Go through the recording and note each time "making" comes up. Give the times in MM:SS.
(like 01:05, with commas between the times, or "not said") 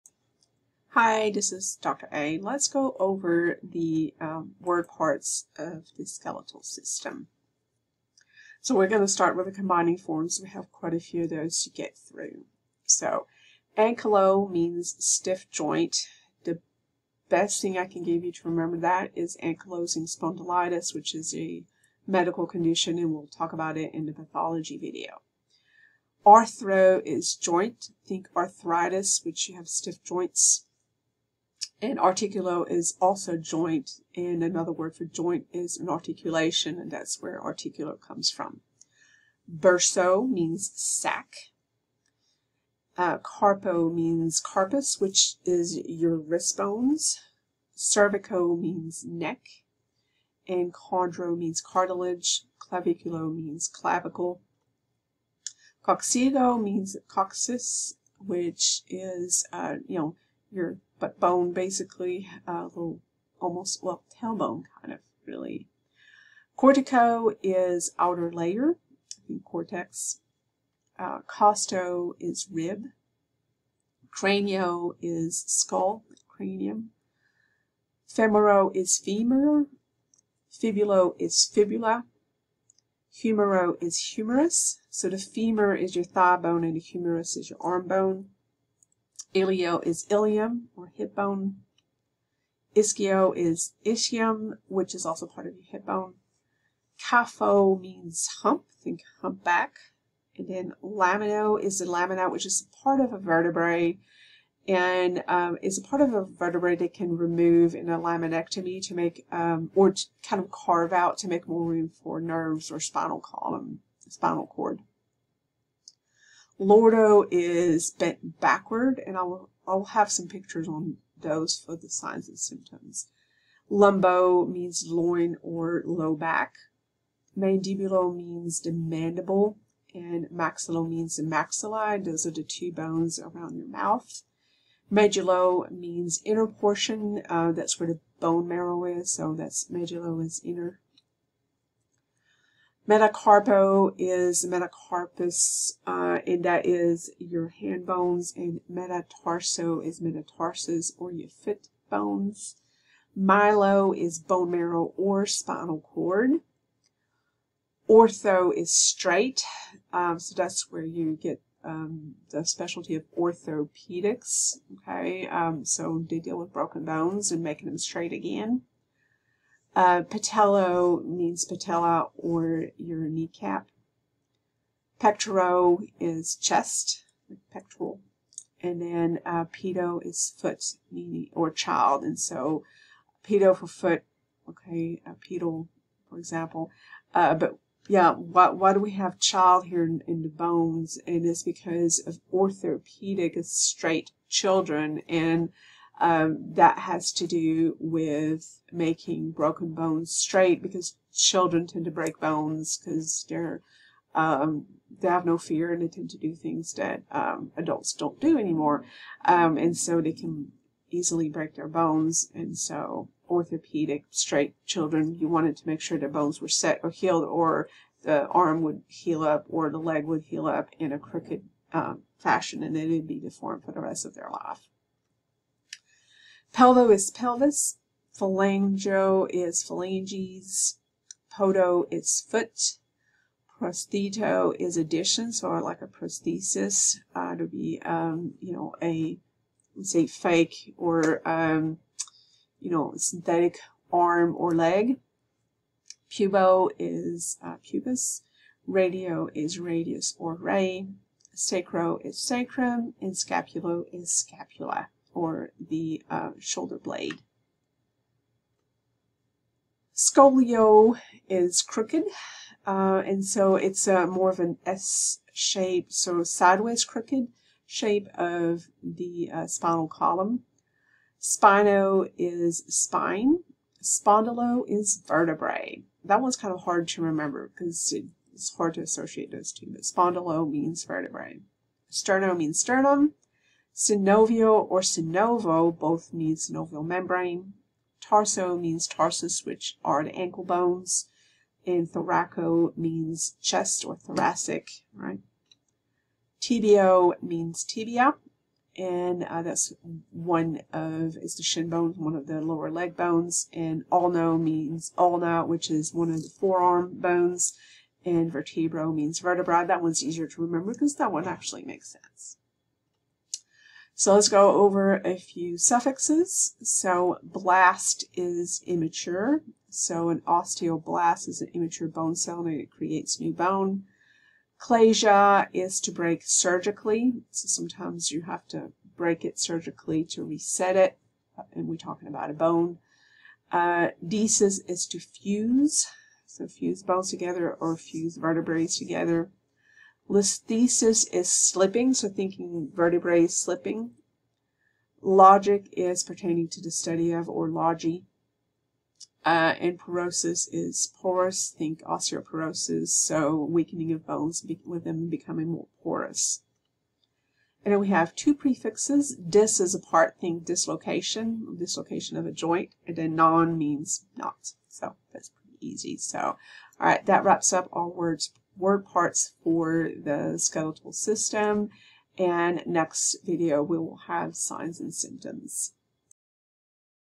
02:47, 03:18.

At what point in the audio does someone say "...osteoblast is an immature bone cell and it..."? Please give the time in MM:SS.
05:20.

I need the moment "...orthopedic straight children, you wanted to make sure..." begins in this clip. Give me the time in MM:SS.
03:33.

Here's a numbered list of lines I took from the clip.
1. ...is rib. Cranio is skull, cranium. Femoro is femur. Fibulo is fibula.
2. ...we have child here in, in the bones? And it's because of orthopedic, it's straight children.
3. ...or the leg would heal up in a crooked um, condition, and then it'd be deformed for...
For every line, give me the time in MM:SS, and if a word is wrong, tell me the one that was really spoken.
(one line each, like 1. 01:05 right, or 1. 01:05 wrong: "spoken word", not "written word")
1. 01:12 right
2. 03:08 right
3. 03:39 wrong: "fashion", not "condition".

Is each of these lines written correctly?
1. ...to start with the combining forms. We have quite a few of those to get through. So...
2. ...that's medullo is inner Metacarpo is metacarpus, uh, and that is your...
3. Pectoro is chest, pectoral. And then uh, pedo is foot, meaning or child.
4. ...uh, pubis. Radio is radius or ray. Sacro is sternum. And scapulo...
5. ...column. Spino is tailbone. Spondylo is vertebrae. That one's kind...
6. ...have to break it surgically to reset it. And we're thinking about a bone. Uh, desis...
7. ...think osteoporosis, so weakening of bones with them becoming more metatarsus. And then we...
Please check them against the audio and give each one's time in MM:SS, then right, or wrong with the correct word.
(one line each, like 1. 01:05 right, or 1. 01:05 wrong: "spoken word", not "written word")
1. 00:09 right
2. 02:19 right
3. 02:54 right
4. 04:07 wrong: "sacrum", not "sternum"
5. 04:29 wrong: "spine", not "tailbone"
6. 05:28 wrong: "talking", not "thinking"
7. 05:51 wrong: "porous", not "metatarsus".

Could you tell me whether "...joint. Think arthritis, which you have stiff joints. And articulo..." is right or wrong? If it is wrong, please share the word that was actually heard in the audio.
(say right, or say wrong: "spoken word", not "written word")
right.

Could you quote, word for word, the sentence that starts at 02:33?
Myelo is bone marrow or spinal cord.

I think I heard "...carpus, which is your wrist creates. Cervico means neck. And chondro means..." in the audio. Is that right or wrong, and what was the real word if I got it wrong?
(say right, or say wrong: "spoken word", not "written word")
wrong: "bones", not "creates".